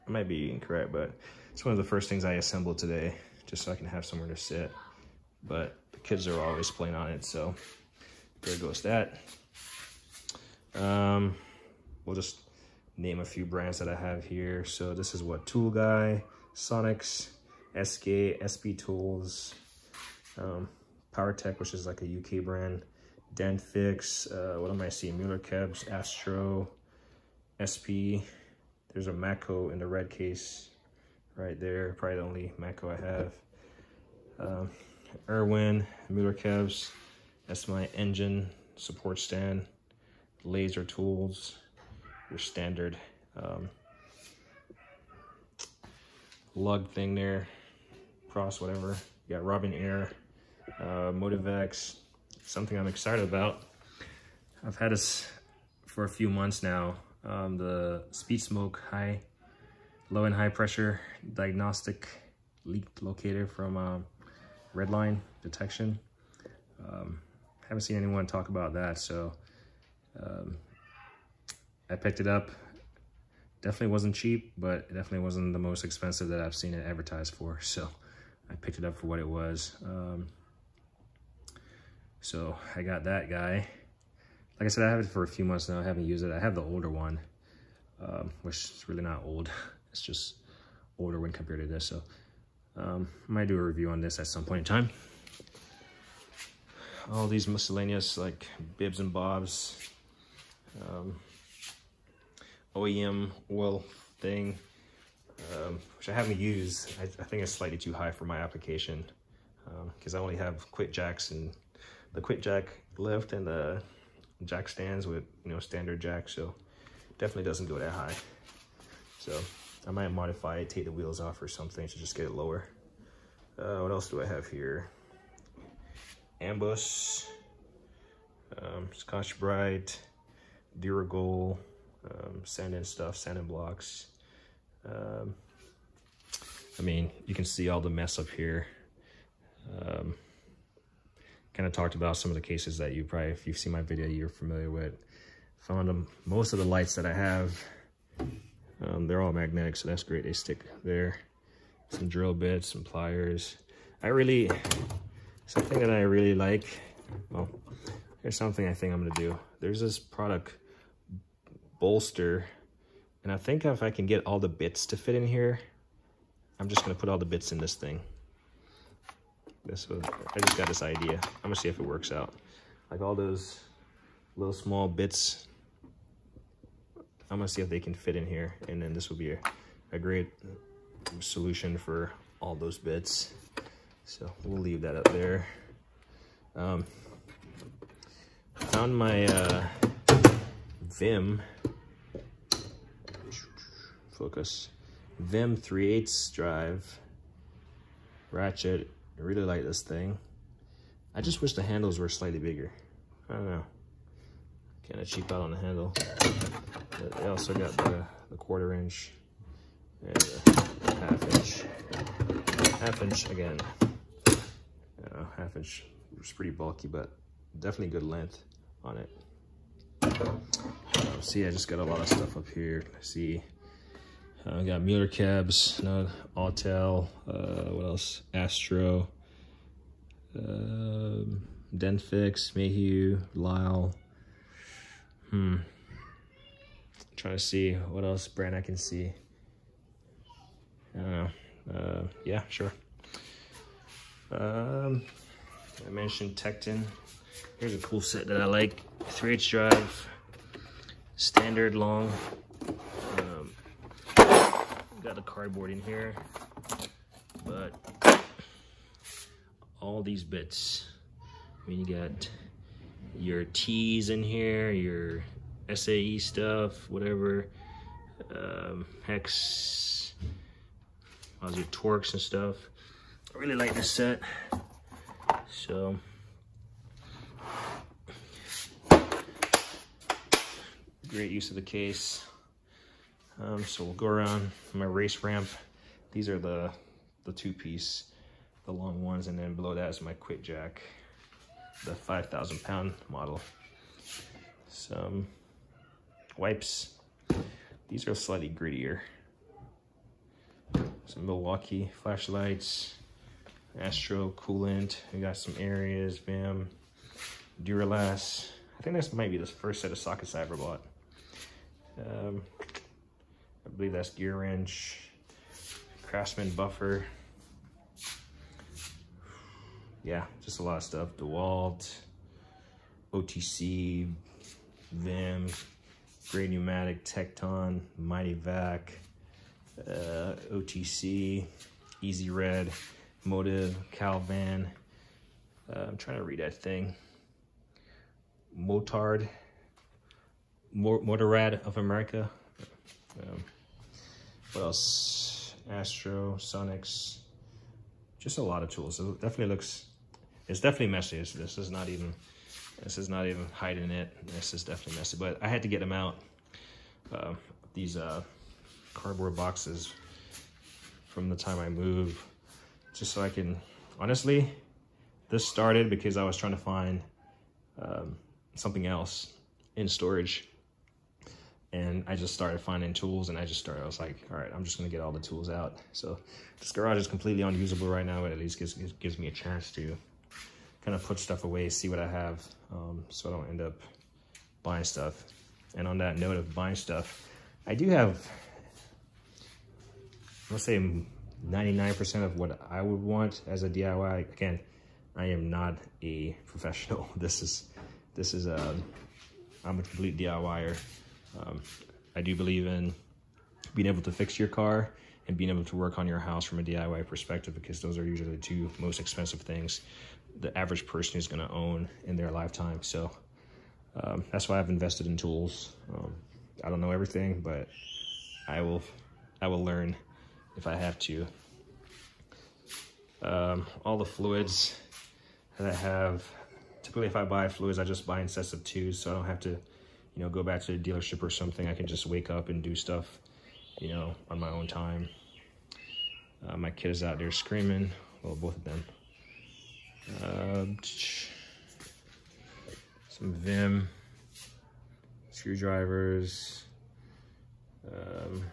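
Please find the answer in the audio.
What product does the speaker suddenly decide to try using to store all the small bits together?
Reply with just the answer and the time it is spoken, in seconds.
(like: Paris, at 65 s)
Bolster, at 161 s.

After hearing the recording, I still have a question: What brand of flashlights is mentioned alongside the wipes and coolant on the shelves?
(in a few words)
Milwaukee.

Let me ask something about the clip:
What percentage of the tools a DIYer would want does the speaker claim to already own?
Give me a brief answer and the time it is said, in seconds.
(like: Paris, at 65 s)
99%, at 390 s.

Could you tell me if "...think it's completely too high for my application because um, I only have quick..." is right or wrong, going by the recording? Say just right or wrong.
wrong.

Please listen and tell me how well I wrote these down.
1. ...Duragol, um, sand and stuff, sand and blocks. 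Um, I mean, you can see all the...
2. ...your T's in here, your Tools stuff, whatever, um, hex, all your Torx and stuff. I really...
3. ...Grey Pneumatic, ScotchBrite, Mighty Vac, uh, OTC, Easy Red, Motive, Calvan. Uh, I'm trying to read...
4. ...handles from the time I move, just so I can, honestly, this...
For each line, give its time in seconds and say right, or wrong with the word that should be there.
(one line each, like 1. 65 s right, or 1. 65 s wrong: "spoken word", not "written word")
1. 130 s right
2. 263 s wrong: "SAE", not "Tools"
3. 326 s wrong: "Tekton", not "ScotchBrite"
4. 359 s wrong: "boxes", not "handles".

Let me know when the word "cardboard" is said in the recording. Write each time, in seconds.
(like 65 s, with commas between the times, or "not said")
255 s, 358 s.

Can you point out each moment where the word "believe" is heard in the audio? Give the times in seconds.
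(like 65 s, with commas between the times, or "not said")
313 s, 402 s.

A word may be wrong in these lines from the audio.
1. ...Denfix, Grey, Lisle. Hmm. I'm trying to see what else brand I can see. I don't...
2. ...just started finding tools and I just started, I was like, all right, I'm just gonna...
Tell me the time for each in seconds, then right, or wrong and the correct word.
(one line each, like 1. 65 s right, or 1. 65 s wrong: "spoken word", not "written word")
1. 231 s wrong: "Mayhew", not "Grey"
2. 372 s right.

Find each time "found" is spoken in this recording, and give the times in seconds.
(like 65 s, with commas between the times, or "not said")
145 s, 188 s.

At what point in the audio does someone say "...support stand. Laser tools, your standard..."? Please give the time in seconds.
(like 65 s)
38 s.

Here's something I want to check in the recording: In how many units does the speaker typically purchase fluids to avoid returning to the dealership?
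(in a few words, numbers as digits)
2.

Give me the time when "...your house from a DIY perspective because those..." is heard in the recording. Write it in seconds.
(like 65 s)
406 s.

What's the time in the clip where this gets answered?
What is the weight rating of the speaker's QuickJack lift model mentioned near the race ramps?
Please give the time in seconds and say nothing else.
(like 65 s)
291 s.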